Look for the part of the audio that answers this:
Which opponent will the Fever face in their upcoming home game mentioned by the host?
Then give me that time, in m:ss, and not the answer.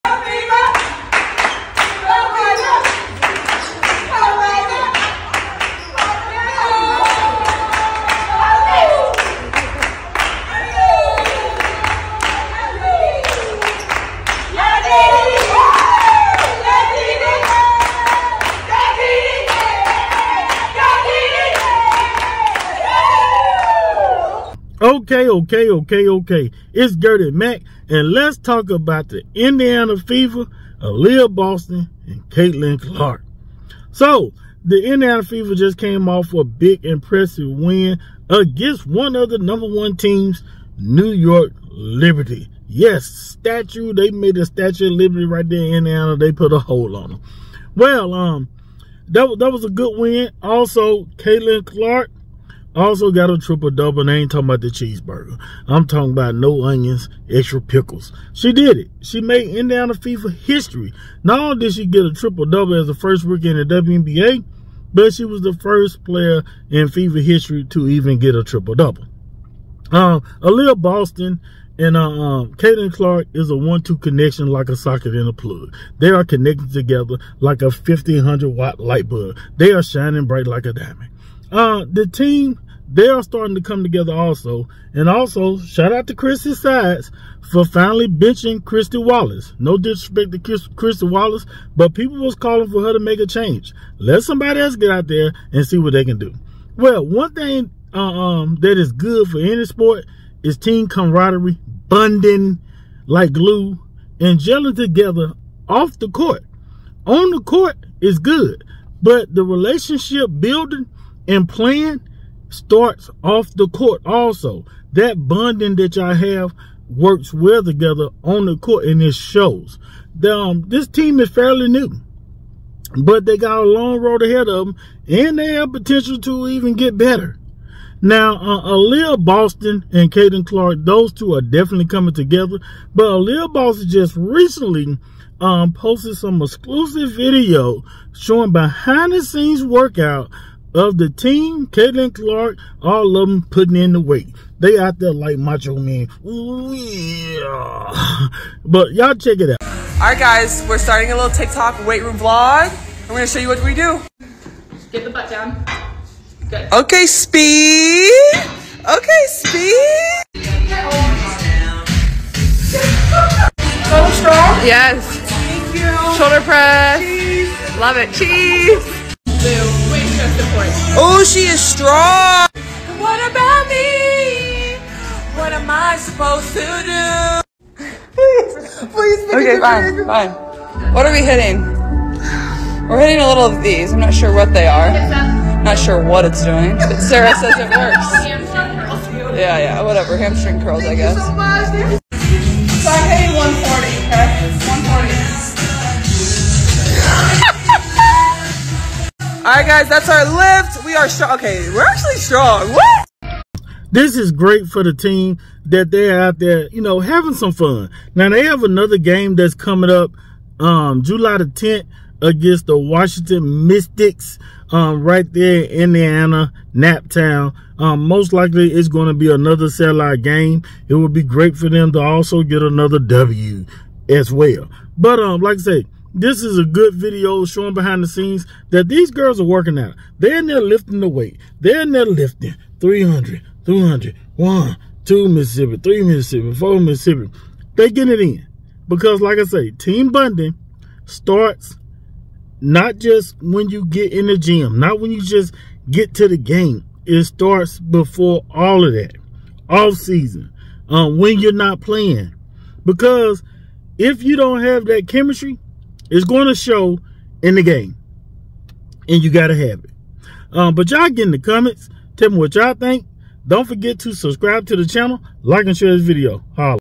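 3:32.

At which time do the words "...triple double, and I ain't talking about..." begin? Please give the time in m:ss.
0:53.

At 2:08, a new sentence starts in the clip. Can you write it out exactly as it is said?
Now, uh, Aliyah Boston and Caitlin Clark, those two are definitely coming together.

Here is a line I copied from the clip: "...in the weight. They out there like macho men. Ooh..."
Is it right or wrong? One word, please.
right.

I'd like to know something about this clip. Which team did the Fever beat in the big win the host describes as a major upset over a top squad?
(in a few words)
New York Liberty.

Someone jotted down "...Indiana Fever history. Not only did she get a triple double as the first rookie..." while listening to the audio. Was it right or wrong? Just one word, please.
right.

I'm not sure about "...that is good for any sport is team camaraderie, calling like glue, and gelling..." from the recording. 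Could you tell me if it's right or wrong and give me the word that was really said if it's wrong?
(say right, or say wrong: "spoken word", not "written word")
wrong: "bonding", not "calling".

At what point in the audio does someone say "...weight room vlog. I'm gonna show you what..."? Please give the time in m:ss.
2:31.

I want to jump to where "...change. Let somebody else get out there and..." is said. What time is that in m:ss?
1:33.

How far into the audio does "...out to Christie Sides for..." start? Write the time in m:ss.
1:25.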